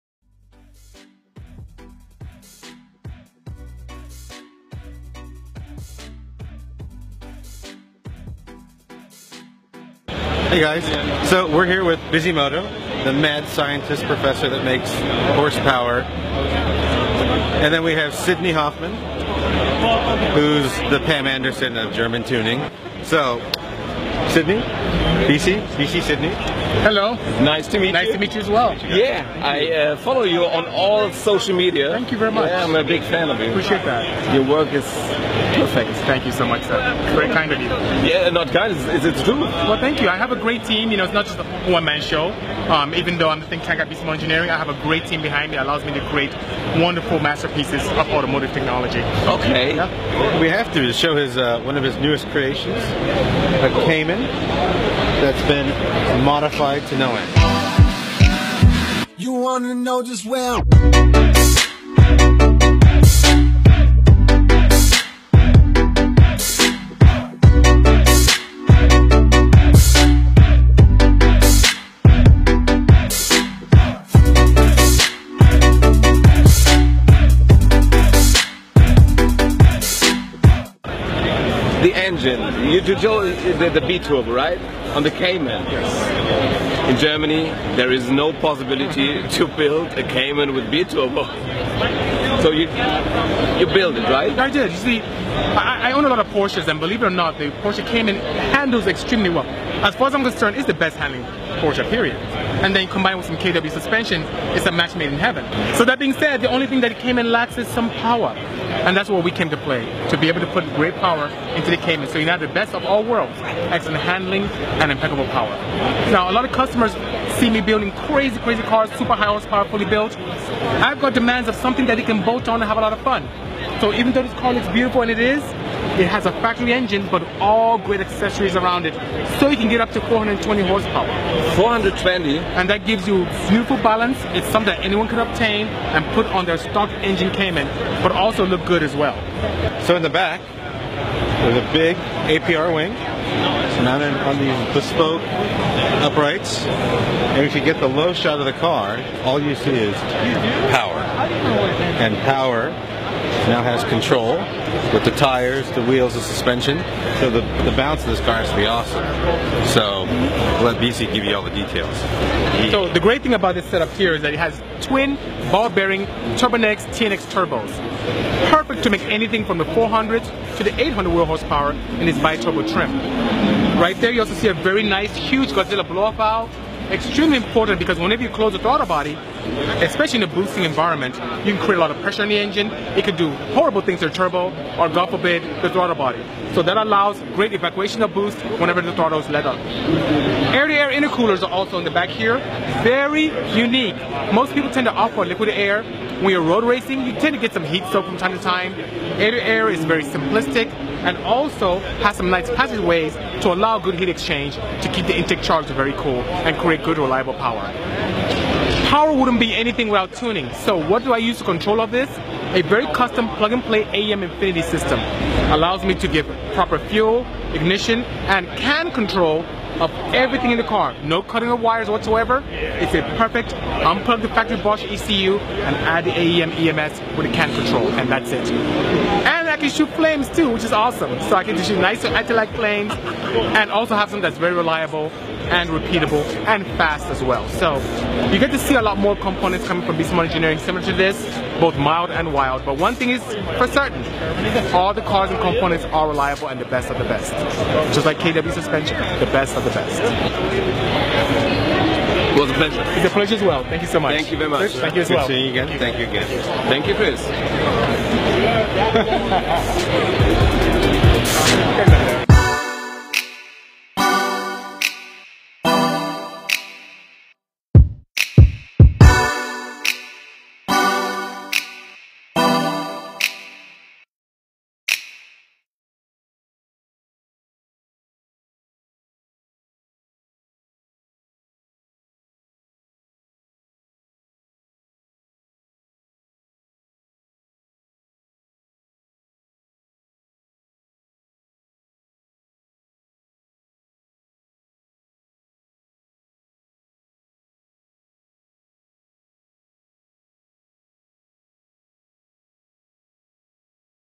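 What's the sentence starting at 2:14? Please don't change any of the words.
It's something that anyone could obtain and put on their stock engine Cayman, but also look good as well.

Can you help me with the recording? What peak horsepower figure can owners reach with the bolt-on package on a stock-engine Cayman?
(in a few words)
420.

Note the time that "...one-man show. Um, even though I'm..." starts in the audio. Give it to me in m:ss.
0:41.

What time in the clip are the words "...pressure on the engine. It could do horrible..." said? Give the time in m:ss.
3:02.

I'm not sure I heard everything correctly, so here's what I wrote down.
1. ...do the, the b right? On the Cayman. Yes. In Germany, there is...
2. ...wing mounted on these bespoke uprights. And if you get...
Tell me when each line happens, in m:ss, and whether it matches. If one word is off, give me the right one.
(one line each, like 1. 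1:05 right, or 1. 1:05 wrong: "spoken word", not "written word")
1. 1:22 right
2. 2:22 right.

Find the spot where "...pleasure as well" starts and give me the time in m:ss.
4:13.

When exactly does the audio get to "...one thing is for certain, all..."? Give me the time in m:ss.
4:02.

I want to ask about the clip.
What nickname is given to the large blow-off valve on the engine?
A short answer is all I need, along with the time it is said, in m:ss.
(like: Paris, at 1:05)
Godzilla, at 2:55.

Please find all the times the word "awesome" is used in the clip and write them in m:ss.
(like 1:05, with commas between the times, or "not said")
2:38, 3:50.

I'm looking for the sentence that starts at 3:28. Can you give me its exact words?
Power wouldn't be anything without tuning.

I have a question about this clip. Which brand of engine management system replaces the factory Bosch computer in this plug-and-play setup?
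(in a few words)
AEM Infinity.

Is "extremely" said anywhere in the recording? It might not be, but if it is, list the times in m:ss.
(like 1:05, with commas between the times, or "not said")
1:38, 2:56.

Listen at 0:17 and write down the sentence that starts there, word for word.
And then we have Sidney Hoffmann, who's the Pam Anderson of German tuning.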